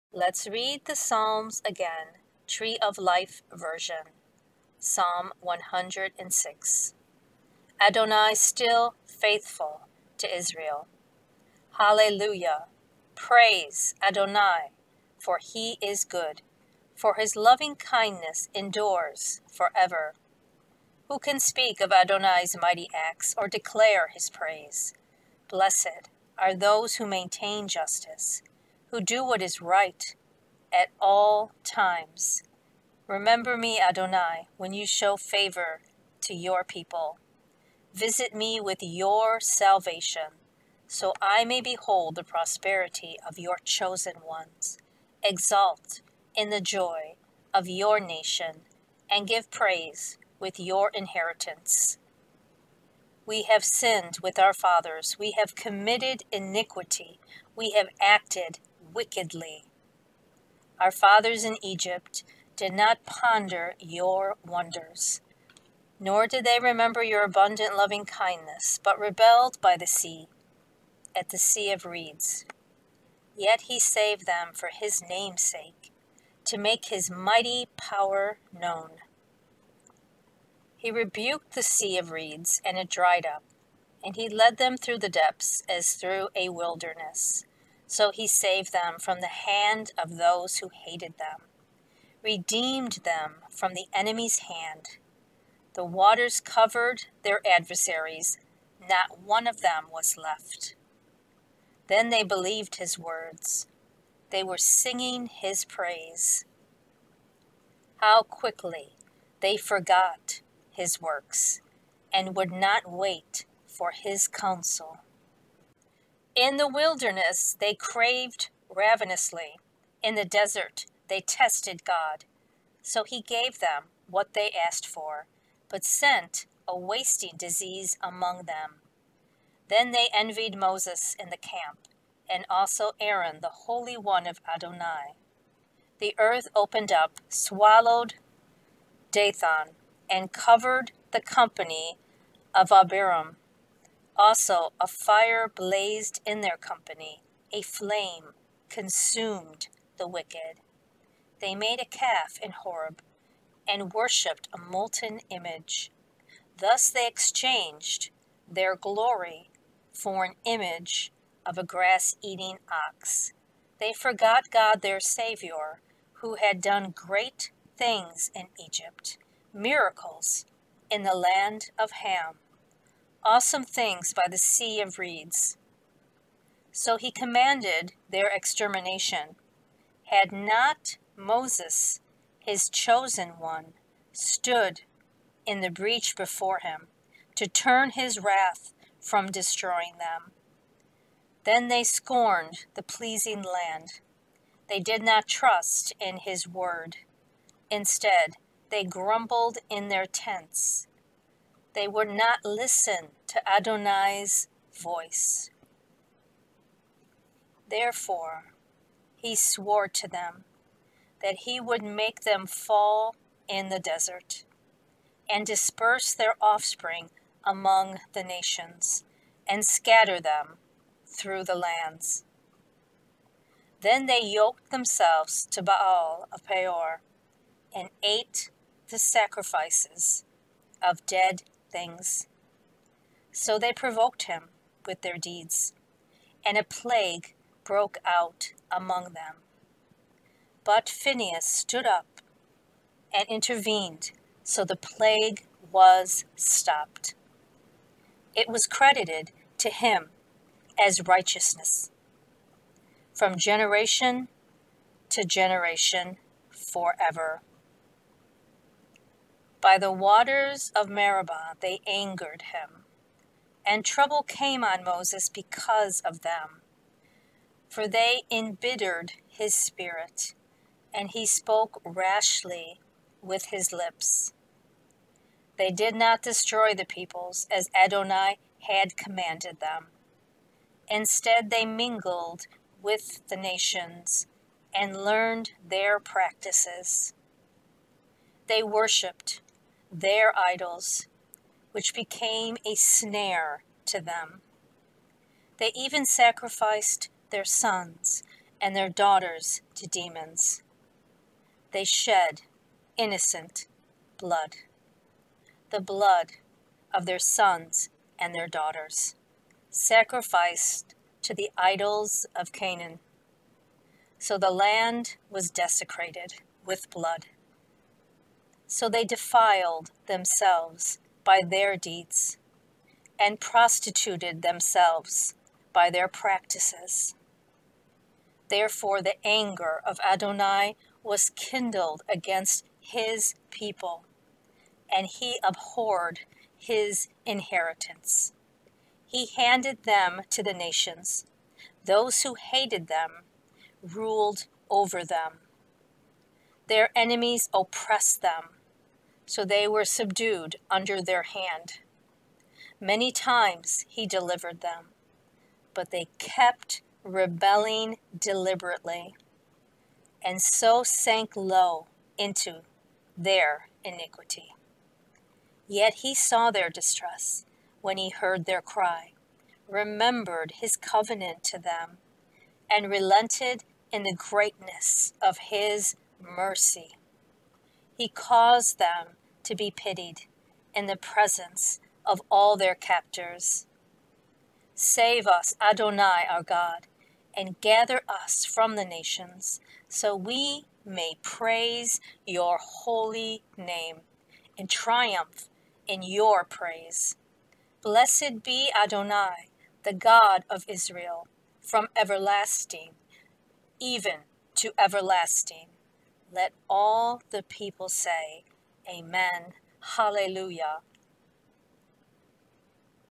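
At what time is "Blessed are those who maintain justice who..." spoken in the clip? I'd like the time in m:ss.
0:25.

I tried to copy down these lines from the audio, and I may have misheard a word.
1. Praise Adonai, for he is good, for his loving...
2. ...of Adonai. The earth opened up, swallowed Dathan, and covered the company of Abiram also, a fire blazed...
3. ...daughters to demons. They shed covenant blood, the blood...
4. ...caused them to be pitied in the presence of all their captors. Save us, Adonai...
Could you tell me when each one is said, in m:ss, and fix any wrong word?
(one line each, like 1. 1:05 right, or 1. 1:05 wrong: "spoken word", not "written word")
1. 0:13 right
2. 2:14 right
3. 4:58 wrong: "innocent", not "covenant"
4. 6:18 right.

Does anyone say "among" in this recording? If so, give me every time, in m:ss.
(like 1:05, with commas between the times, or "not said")
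2:08, 3:37, 3:58.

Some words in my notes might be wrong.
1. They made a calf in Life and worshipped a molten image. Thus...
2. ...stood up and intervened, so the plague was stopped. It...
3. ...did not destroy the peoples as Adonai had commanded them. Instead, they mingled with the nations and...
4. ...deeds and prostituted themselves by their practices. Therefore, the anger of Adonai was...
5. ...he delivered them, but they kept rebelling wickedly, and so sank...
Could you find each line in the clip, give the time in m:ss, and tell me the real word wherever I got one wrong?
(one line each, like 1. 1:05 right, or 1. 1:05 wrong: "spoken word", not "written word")
1. 2:31 wrong: "Horeb", not "Life"
2. 4:01 right
3. 4:35 right
4. 5:21 right
5. 5:53 wrong: "deliberately", not "wickedly".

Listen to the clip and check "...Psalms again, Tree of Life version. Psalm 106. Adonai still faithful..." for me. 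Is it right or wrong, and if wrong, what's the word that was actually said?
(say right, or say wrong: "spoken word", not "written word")
right.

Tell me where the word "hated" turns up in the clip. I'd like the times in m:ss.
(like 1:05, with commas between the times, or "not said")
1:30, 5:42.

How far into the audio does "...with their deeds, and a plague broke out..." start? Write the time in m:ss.
3:54.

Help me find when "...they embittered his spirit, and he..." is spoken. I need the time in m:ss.
4:27.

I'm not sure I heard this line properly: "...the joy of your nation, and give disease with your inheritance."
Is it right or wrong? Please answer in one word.
wrong.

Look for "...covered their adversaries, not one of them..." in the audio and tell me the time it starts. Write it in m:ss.
1:36.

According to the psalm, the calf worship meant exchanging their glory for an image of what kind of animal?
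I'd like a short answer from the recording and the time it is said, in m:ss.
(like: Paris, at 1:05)
A grass eating ox, at 2:41.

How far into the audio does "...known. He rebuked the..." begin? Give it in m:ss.
1:18.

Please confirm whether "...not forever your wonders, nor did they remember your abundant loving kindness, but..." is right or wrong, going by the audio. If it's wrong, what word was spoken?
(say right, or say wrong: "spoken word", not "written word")
wrong: "ponder", not "forever".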